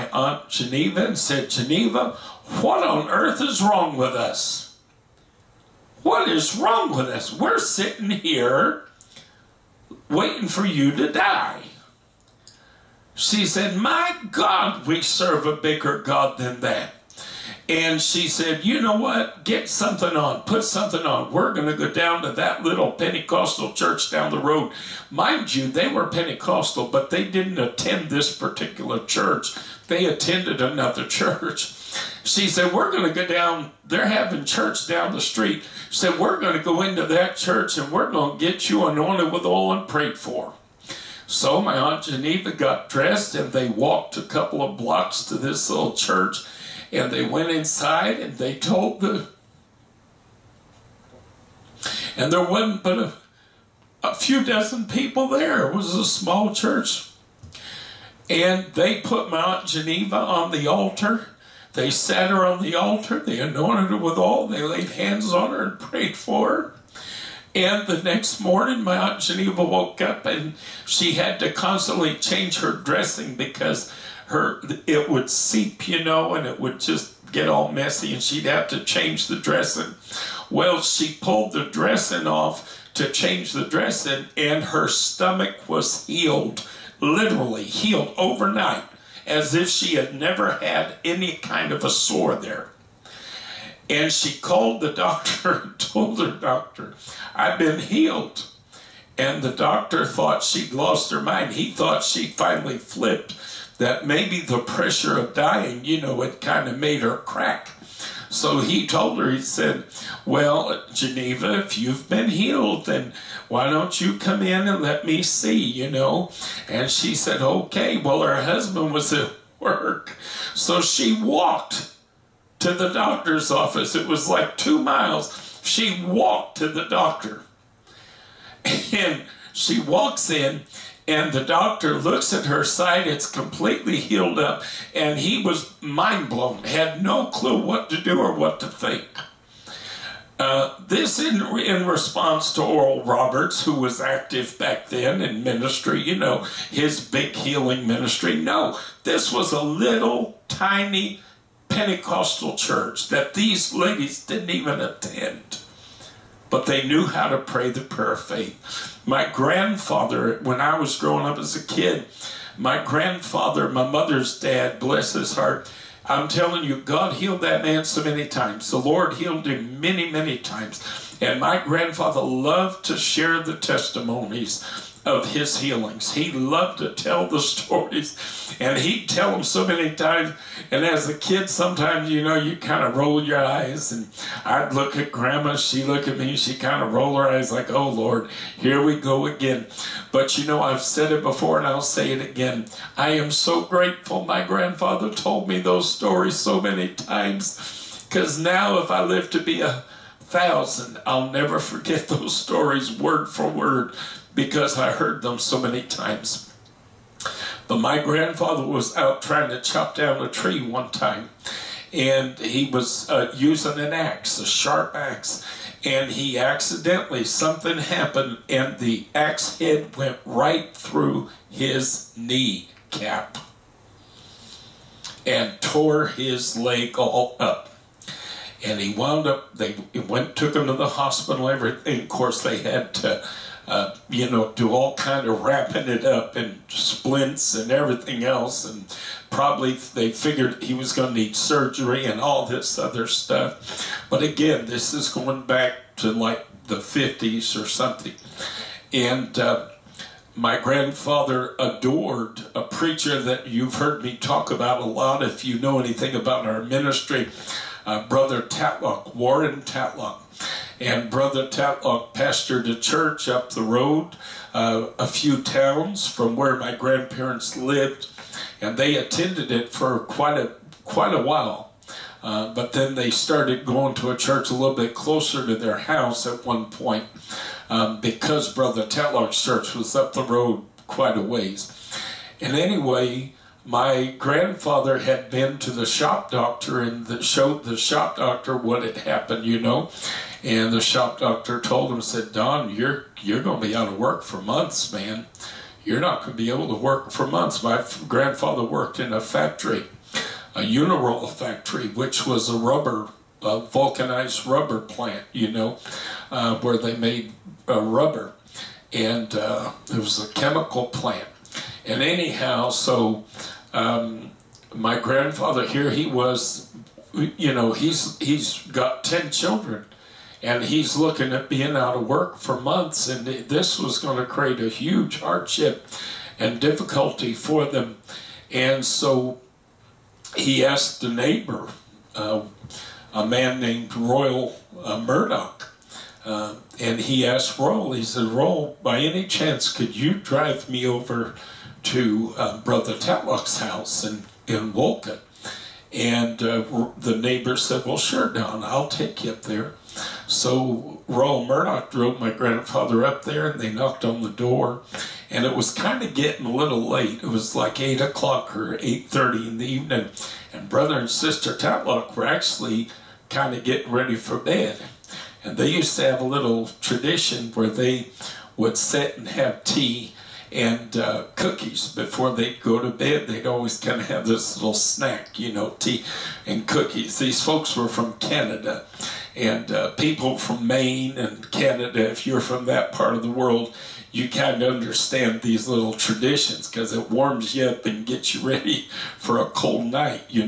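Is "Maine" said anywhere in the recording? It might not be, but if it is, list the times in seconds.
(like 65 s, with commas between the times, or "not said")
380 s.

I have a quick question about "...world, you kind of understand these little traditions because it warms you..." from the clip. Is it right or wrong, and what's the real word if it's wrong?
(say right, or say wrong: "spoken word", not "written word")
right.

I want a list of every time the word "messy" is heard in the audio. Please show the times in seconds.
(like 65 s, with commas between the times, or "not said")
77 s.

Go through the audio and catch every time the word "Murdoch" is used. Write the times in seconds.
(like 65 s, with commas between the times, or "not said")
335 s, 351 s.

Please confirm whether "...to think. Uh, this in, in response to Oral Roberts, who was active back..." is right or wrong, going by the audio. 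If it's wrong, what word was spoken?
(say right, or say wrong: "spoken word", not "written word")
right.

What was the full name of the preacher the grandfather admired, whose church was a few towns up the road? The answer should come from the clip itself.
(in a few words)
Warren Tatlock.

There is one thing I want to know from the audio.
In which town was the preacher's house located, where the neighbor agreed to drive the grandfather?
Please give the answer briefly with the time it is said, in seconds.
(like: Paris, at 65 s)
Wolcott, at 344 s.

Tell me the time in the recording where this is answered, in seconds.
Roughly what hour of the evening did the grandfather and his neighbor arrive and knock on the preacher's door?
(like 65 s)
357 s.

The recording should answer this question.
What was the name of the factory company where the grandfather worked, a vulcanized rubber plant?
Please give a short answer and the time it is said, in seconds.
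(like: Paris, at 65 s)
Uniroyal, at 300 s.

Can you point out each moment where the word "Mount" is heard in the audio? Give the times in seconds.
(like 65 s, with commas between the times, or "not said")
59 s.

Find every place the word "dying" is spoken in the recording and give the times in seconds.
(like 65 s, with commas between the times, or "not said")
105 s.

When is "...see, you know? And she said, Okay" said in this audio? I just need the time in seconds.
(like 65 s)
115 s.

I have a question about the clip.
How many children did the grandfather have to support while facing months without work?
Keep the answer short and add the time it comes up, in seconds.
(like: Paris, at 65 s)
10, at 319 s.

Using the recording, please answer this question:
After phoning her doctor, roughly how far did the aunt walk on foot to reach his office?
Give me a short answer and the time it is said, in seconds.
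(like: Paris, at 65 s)
2 miles, at 124 s.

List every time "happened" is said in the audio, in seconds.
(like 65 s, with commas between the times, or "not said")
217 s, 288 s.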